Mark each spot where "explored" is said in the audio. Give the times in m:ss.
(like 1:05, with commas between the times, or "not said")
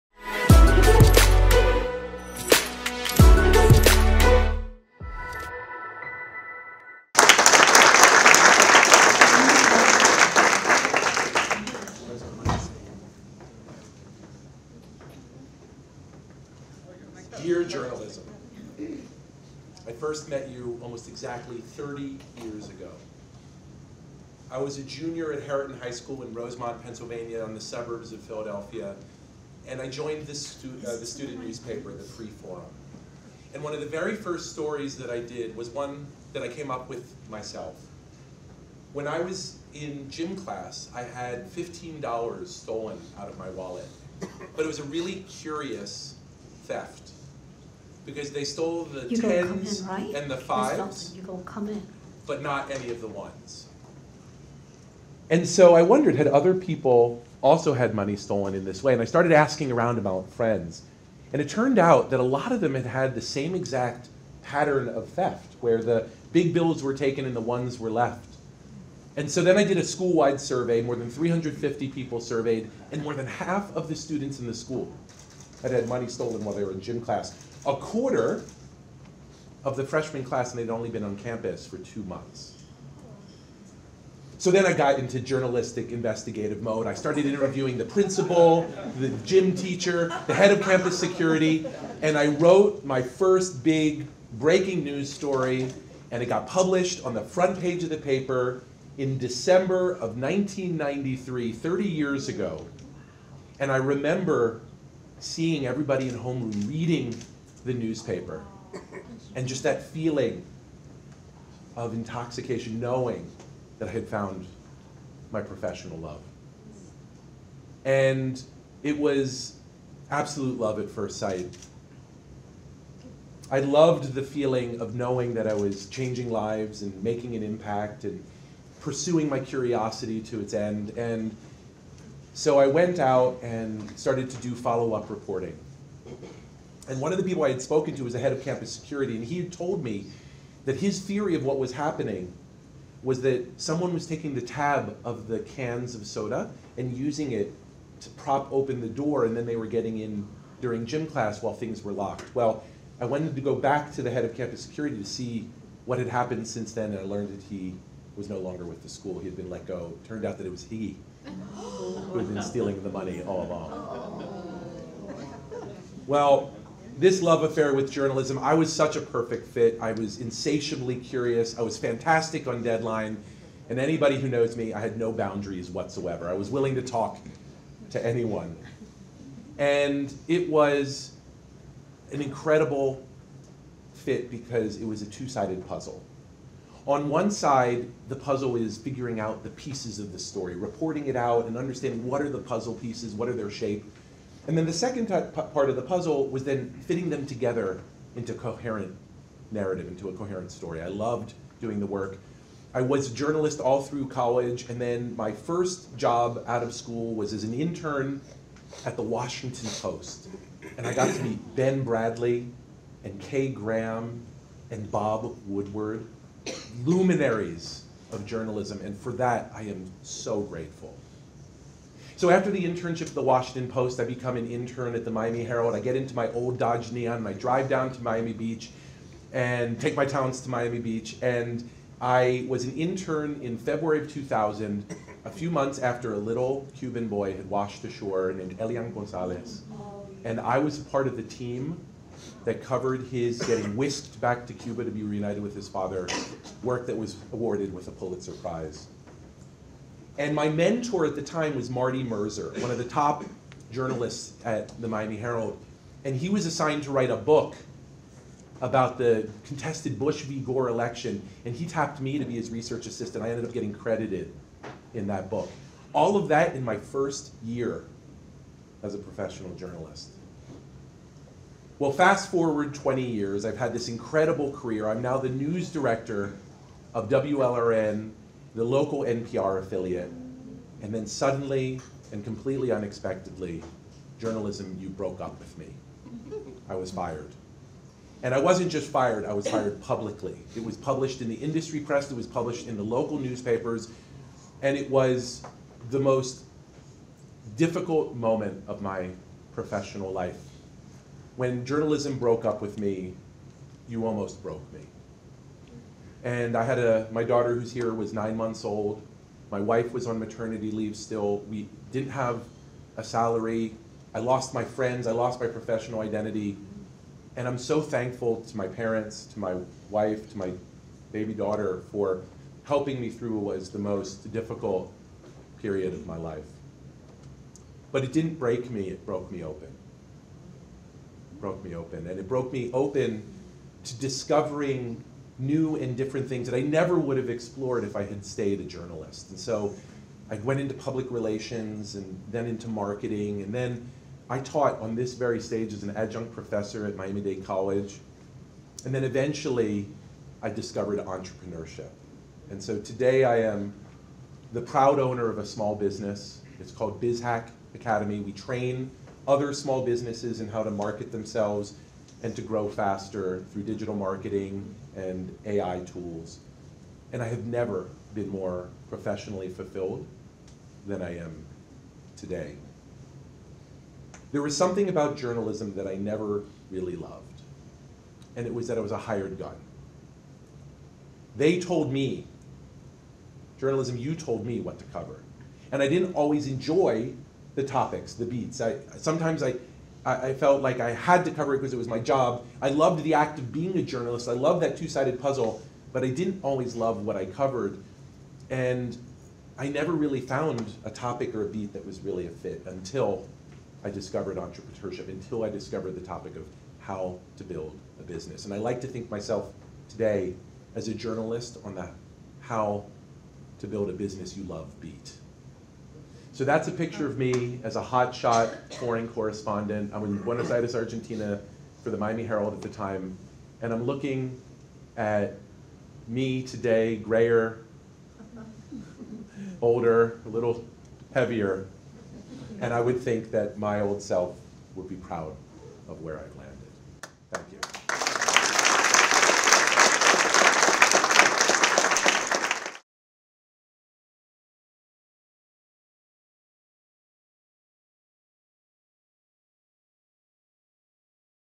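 5:37.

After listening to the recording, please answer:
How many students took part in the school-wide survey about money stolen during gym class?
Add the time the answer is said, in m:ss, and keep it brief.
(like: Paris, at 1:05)
more than 350, at 1:10.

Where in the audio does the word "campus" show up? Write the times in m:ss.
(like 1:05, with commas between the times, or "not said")
1:21, 1:30, 2:18, 2:34.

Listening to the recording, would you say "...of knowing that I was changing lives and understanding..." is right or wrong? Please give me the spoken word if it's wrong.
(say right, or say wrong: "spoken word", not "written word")
wrong: "making", not "understanding".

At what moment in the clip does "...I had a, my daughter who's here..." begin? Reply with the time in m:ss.
5:06.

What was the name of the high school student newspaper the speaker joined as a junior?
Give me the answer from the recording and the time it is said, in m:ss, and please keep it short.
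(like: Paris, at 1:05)
Free Forum, at 0:31.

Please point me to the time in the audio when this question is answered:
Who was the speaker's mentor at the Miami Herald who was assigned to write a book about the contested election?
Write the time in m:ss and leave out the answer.
4:11.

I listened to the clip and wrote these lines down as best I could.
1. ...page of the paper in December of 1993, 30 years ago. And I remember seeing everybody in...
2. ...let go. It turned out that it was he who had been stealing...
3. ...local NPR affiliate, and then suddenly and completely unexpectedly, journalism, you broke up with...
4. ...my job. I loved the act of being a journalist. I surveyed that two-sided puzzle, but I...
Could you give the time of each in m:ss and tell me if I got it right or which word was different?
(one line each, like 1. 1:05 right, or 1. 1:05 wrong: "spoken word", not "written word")
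1. 1:37 right
2. 2:39 right
3. 4:38 right
4. 6:31 wrong: "loved", not "surveyed".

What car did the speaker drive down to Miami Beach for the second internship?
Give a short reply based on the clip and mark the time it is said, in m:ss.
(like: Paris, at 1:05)
Dodge Neon, at 3:46.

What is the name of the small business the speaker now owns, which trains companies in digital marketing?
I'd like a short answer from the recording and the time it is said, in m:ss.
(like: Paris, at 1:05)
BizHack Academy, at 5:57.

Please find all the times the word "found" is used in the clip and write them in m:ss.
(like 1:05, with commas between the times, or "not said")
1:54, 6:40.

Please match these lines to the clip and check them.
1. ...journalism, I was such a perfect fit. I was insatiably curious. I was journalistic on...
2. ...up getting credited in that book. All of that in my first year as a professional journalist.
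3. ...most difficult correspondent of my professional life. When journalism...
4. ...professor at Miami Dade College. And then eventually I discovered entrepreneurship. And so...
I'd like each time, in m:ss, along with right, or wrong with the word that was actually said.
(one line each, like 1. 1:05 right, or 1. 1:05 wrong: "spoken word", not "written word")
1. 2:47 wrong: "fantastic", not "journalistic"
2. 4:23 right
3. 4:55 wrong: "moment", not "correspondent"
4. 5:46 right.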